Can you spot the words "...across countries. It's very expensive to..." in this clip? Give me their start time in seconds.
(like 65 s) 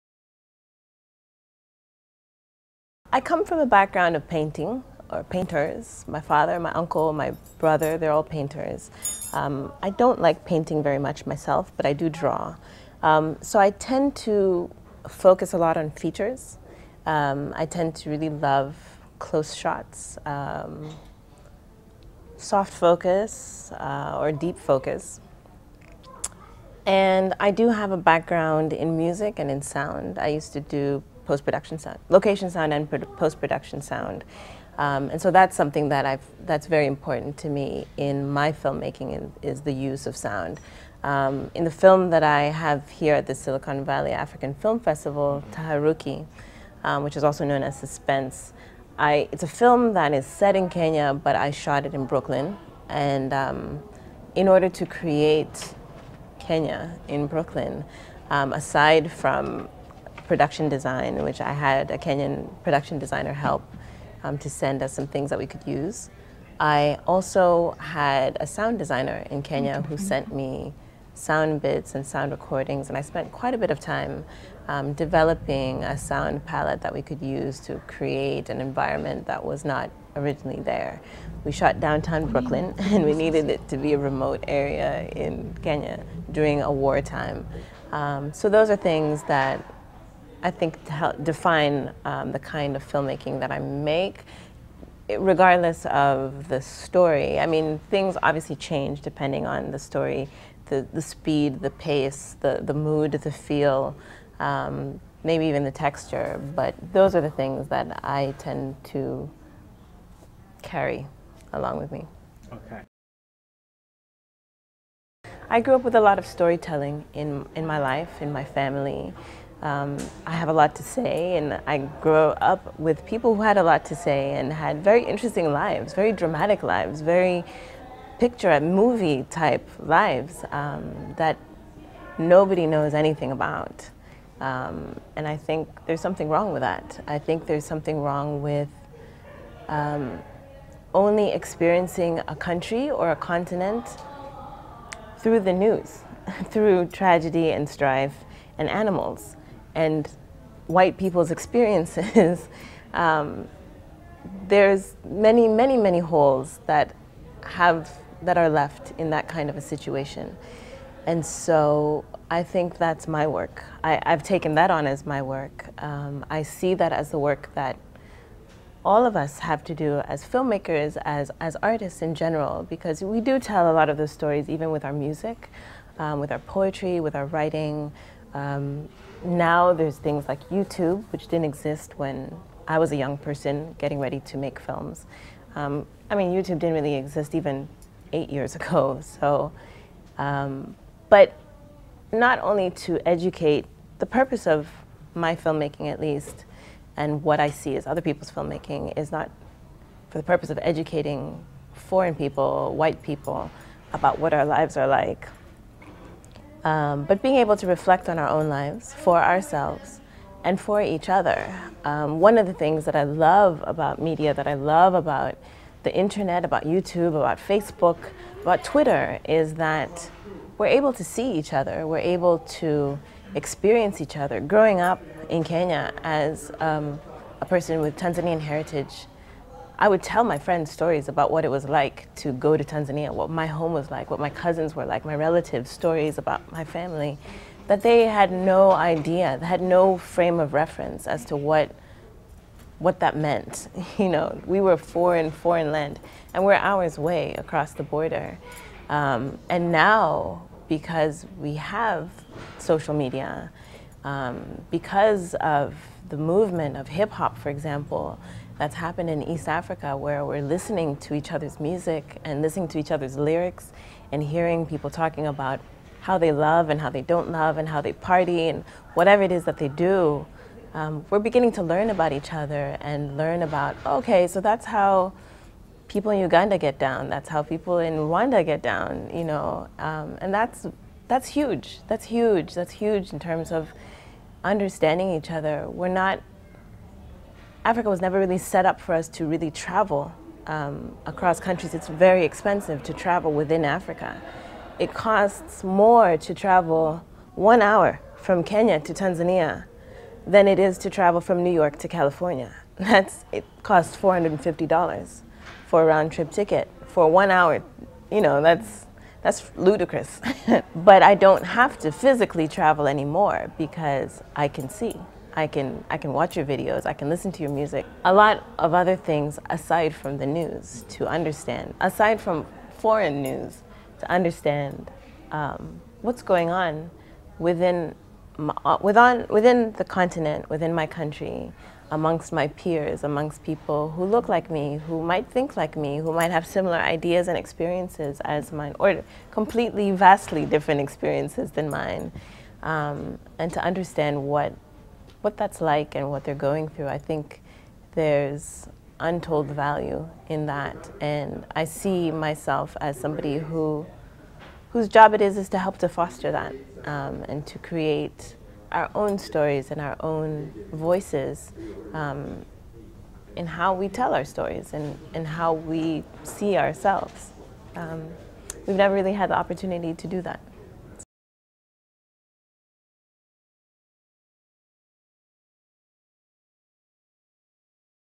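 291 s.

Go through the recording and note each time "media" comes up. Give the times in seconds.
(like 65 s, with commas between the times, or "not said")
214 s, 252 s.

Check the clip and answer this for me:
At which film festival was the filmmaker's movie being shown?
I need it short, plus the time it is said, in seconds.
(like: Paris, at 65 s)
Silicon Valley African Film Festival, at 43 s.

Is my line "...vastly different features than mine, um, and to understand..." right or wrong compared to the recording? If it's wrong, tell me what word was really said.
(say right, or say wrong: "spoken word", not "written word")
wrong: "experiences", not "features".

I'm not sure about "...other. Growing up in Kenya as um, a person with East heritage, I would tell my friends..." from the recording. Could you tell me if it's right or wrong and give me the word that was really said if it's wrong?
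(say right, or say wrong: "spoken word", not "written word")
wrong: "Tanzanian", not "East".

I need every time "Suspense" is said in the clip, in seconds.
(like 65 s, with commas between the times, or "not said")
47 s.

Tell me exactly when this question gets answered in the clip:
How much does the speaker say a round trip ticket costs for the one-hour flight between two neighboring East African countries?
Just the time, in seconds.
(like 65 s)
303 s.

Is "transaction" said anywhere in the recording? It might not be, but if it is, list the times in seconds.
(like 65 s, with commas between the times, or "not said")
not said.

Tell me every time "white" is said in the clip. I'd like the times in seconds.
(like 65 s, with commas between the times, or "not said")
150 s, 202 s.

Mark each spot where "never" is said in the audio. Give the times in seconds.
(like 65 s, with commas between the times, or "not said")
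288 s, 368 s.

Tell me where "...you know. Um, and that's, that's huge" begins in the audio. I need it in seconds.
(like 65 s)
279 s.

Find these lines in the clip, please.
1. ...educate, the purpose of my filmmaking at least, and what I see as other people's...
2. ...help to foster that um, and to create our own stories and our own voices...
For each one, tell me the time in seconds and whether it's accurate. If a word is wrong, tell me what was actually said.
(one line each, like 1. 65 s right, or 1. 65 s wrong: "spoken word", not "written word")
1. 193 s right
2. 355 s right.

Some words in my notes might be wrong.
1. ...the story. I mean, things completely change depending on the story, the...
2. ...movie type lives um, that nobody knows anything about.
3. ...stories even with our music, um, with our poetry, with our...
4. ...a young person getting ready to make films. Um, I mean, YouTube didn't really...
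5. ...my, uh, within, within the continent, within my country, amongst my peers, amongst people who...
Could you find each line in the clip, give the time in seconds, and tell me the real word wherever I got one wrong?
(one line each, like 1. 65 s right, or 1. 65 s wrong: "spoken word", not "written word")
1. 96 s wrong: "obviously", not "completely"
2. 128 s right
3. 174 s right
4. 182 s right
5. 328 s right.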